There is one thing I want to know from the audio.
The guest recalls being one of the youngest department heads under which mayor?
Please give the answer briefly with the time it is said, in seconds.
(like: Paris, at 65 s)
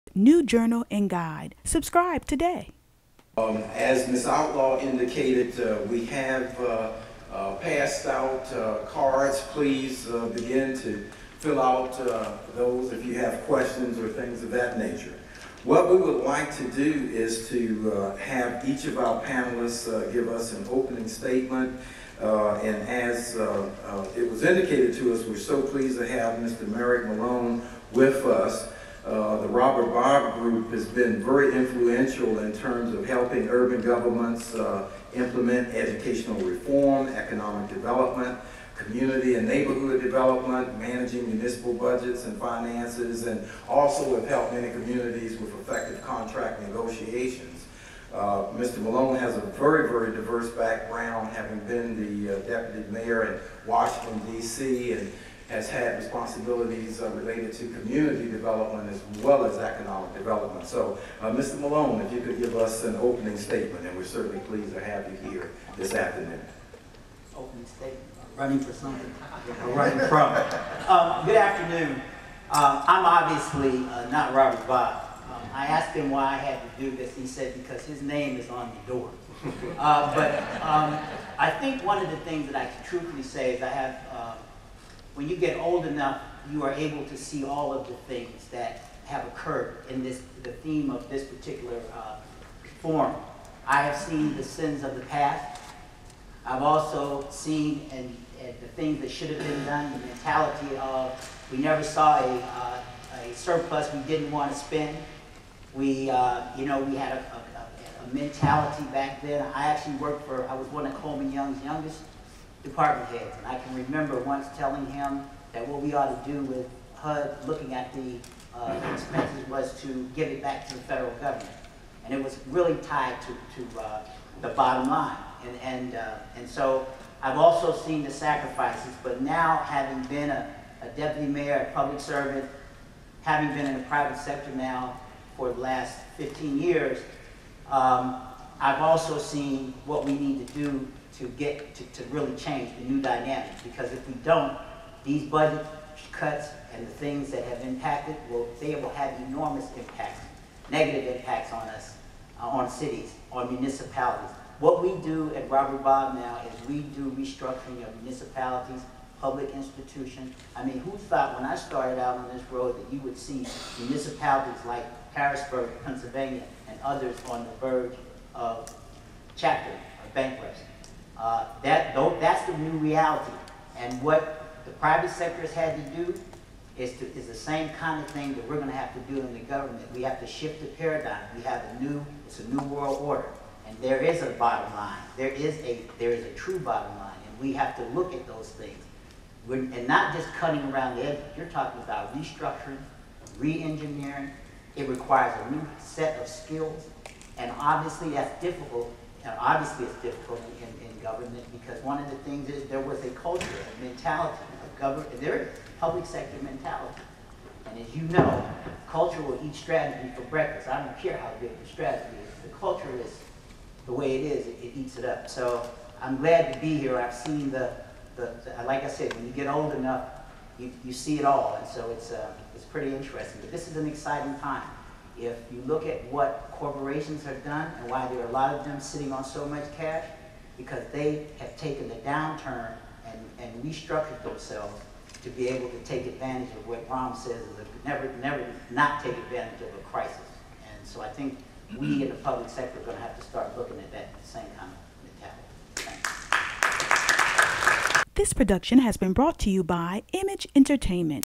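Coleman Young, at 110 s.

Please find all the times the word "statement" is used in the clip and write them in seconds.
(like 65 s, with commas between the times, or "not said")
21 s, 63 s, 67 s.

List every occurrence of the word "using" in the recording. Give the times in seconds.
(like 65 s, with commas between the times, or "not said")
not said.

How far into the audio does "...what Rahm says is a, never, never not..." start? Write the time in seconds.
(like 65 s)
236 s.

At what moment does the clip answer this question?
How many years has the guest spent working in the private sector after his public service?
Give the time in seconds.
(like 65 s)
136 s.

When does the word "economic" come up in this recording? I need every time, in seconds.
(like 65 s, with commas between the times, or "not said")
37 s, 59 s.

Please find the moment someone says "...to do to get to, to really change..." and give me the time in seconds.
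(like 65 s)
140 s.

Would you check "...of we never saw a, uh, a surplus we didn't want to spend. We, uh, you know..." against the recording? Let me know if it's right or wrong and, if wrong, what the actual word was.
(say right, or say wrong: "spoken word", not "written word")
right.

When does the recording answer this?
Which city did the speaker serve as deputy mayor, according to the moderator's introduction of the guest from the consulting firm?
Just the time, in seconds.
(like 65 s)
53 s.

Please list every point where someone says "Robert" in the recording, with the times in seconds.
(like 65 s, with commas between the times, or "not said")
29 s, 74 s, 155 s.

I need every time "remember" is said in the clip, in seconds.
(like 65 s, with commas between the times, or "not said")
113 s.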